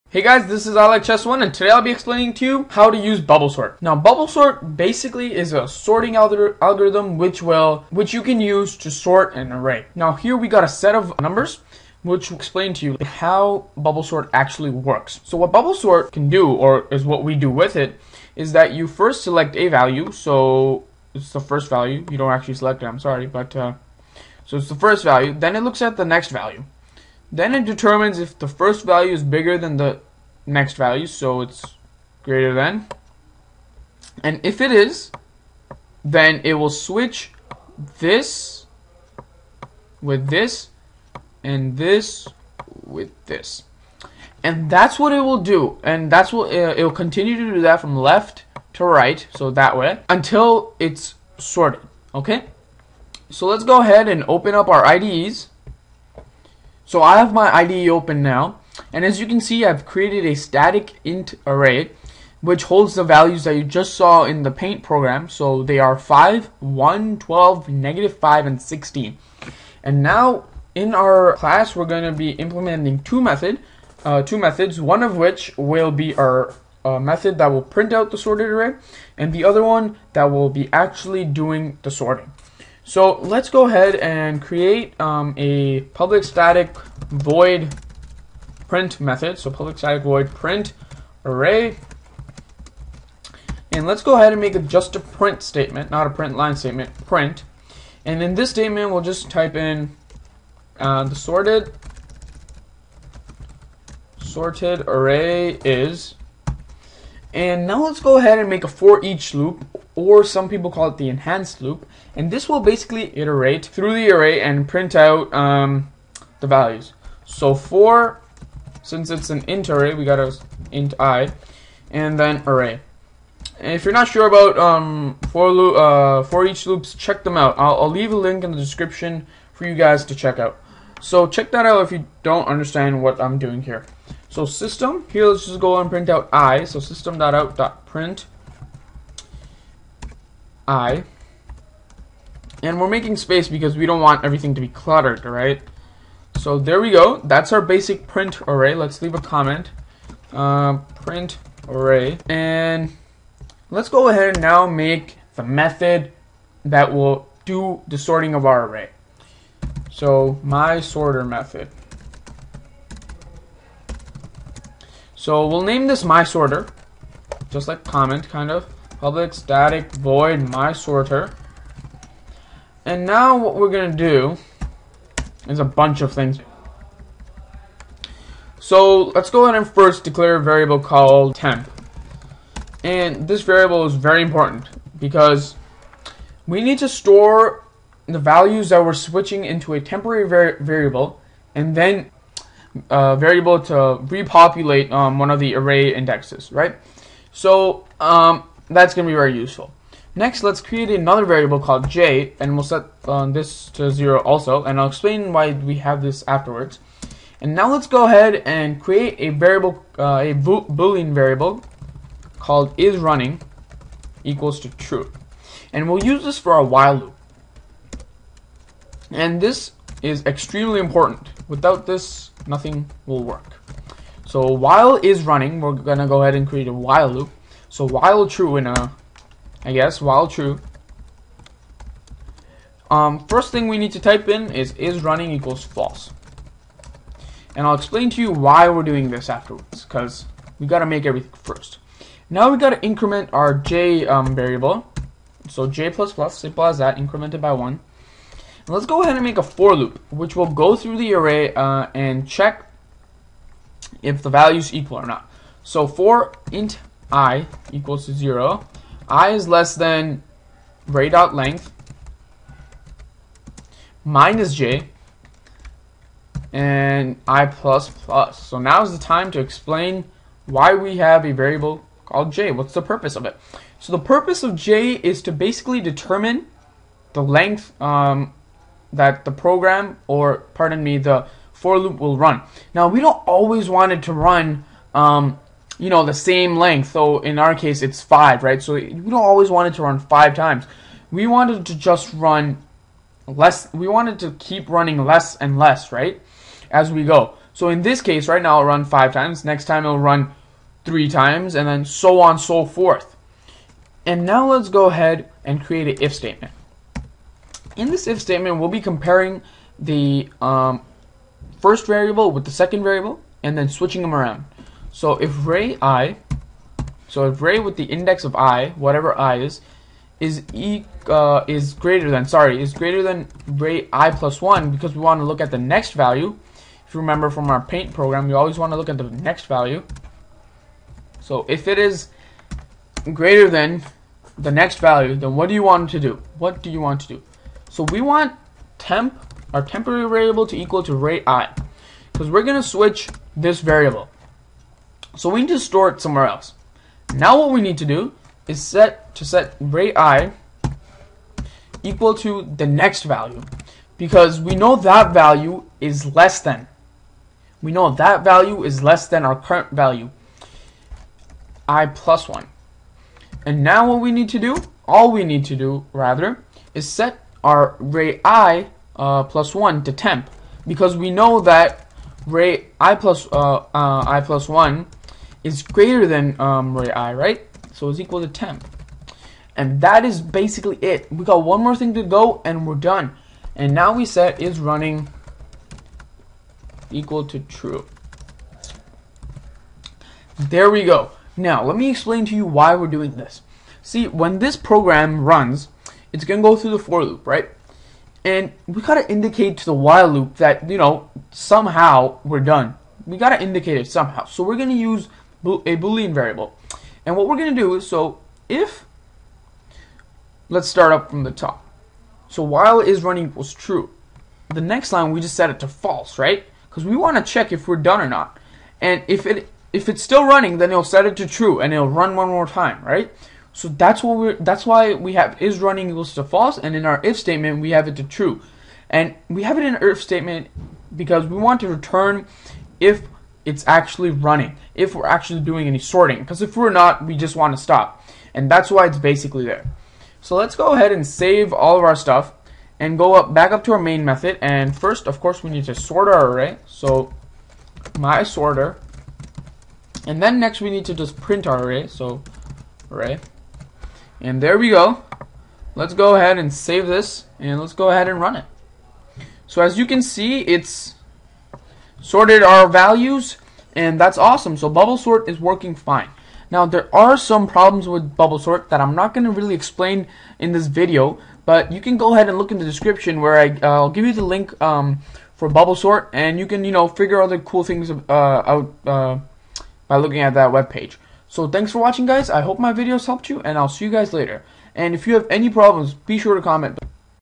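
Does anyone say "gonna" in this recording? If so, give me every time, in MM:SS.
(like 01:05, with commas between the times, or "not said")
02:53, 03:45.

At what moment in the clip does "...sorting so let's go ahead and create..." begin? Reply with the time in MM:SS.
01:22.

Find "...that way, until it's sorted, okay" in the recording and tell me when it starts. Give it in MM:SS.
00:49.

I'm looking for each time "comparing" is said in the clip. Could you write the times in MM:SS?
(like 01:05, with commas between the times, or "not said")
05:08.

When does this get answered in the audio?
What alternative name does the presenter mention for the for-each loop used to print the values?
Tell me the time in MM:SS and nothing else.
01:51.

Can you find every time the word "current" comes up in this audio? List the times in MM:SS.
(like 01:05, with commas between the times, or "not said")
05:59.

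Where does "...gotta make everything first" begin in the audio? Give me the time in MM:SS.
04:00.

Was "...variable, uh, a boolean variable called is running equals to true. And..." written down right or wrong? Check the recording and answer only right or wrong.
right.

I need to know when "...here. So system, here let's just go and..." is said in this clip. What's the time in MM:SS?
02:13.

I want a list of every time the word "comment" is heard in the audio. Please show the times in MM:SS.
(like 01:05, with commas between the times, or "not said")
02:29, 02:47, 08:06.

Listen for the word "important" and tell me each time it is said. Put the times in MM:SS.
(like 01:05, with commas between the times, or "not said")
03:04, 03:40.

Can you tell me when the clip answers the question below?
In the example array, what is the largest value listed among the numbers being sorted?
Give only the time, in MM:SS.
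01:08.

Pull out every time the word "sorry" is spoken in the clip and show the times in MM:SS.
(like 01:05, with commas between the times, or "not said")
00:22, 05:22.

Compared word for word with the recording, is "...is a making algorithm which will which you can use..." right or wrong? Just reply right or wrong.
wrong.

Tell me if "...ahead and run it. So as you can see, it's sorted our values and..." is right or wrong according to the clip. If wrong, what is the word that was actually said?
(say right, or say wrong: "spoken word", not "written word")
right.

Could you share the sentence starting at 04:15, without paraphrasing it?
So for int i equals to 0, i is less than array dot length minus j and i plus plus.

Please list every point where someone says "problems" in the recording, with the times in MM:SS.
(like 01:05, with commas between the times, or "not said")
07:47, 08:05.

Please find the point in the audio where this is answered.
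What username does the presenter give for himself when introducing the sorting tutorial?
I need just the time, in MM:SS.
00:00.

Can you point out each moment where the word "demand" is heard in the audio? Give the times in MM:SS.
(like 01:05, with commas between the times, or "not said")
not said.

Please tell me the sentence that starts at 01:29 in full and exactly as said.
So public static void print array.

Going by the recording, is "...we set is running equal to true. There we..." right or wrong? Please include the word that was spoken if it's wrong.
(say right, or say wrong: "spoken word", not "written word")
right.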